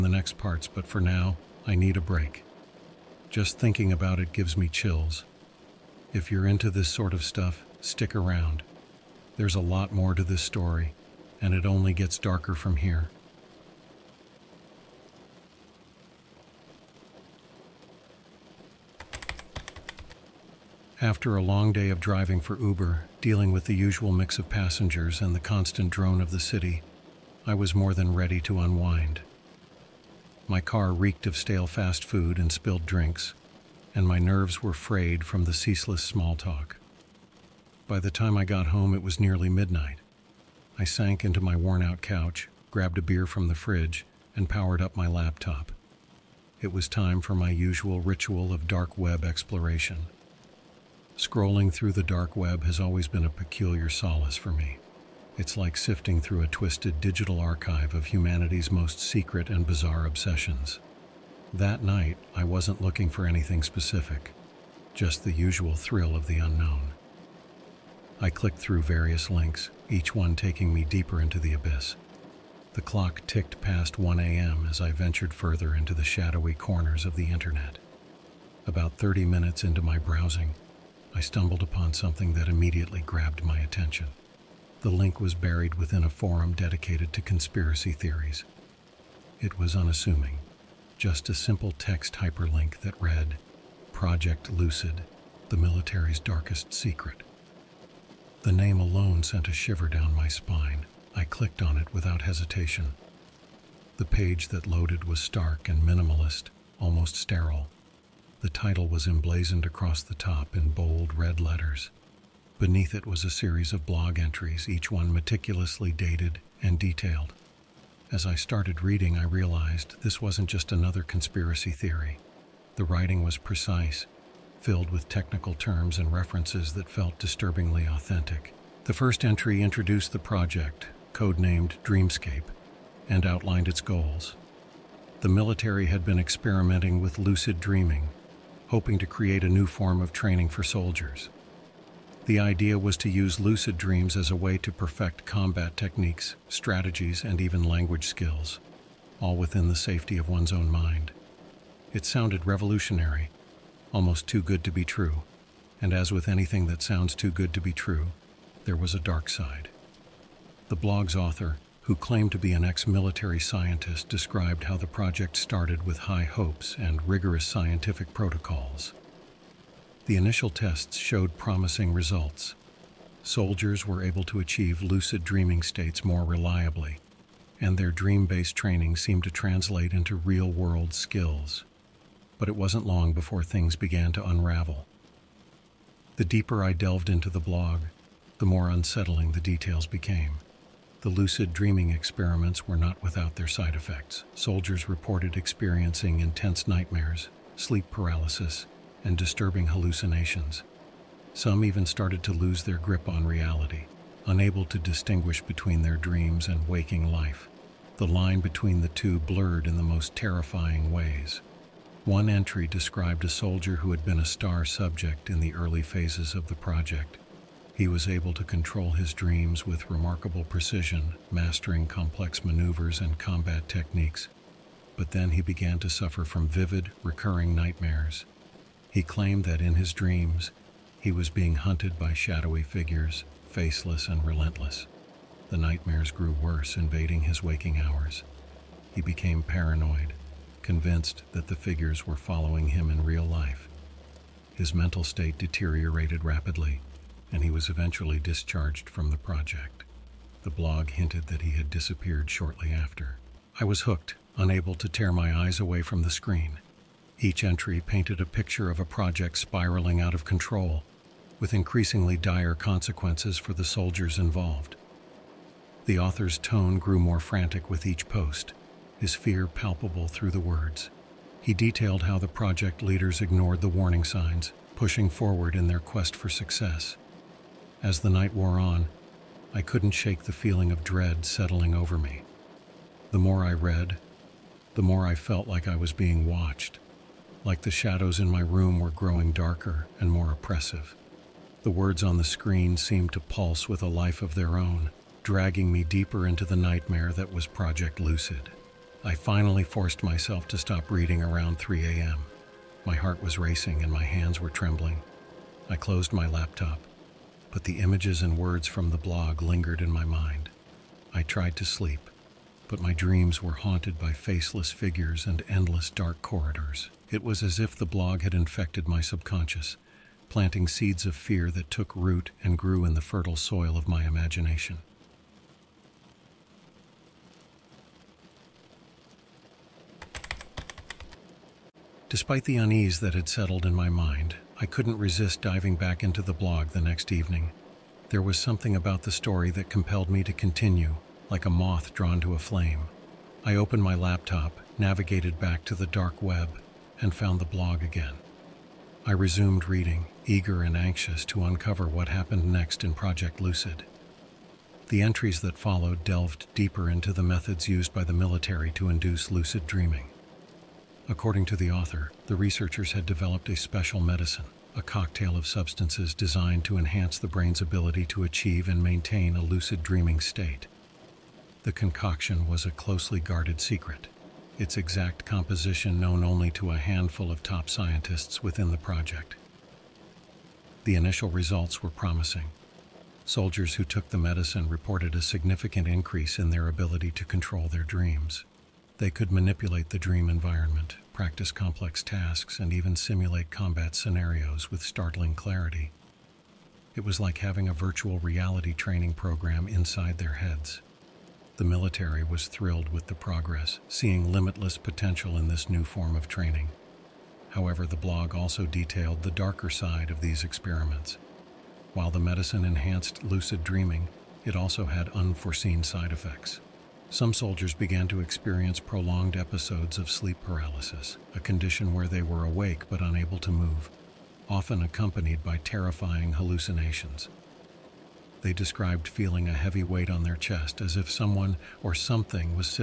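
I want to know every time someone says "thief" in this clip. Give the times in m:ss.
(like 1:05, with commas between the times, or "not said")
not said.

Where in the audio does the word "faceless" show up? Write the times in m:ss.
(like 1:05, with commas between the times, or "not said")
3:53, 5:14.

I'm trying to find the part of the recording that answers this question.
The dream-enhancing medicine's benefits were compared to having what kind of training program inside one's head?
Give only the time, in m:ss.
6:37.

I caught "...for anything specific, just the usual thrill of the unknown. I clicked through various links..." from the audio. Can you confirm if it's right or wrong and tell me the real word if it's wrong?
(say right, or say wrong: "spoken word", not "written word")
right.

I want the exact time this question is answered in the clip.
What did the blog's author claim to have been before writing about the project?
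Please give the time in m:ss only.
2:42.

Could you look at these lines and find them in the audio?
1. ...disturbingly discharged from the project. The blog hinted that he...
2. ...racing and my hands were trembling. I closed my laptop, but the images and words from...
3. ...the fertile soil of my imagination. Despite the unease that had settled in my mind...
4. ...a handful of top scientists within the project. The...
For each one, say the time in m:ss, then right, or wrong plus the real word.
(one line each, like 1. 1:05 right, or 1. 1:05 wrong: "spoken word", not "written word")
1. 4:07 wrong: "eventually", not "disturbingly"
2. 5:03 right
3. 5:22 right
4. 6:16 right.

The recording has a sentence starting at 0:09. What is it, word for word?
There's a lot more to this story, and it only gets darker from here.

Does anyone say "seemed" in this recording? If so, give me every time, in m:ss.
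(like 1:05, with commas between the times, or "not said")
2:58, 4:52.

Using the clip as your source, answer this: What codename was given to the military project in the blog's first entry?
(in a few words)
Dreamscape.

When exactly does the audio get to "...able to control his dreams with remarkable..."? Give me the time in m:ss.
3:38.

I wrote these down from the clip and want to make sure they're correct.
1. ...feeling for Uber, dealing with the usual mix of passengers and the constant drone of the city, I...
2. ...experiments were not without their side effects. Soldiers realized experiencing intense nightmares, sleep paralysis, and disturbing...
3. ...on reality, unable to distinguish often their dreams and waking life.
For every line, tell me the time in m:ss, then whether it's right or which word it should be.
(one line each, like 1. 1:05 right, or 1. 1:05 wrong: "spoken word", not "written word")
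1. 0:21 wrong: "driving", not "feeling"
2. 3:11 wrong: "reported", not "realized"
3. 3:23 wrong: "between", not "often".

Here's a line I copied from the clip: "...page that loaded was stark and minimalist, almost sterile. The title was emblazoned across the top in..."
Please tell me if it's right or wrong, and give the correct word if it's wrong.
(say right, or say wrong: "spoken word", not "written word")
right.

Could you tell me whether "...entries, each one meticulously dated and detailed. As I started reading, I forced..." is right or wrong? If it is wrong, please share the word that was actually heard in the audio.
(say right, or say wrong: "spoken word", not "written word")
wrong: "realized", not "forced".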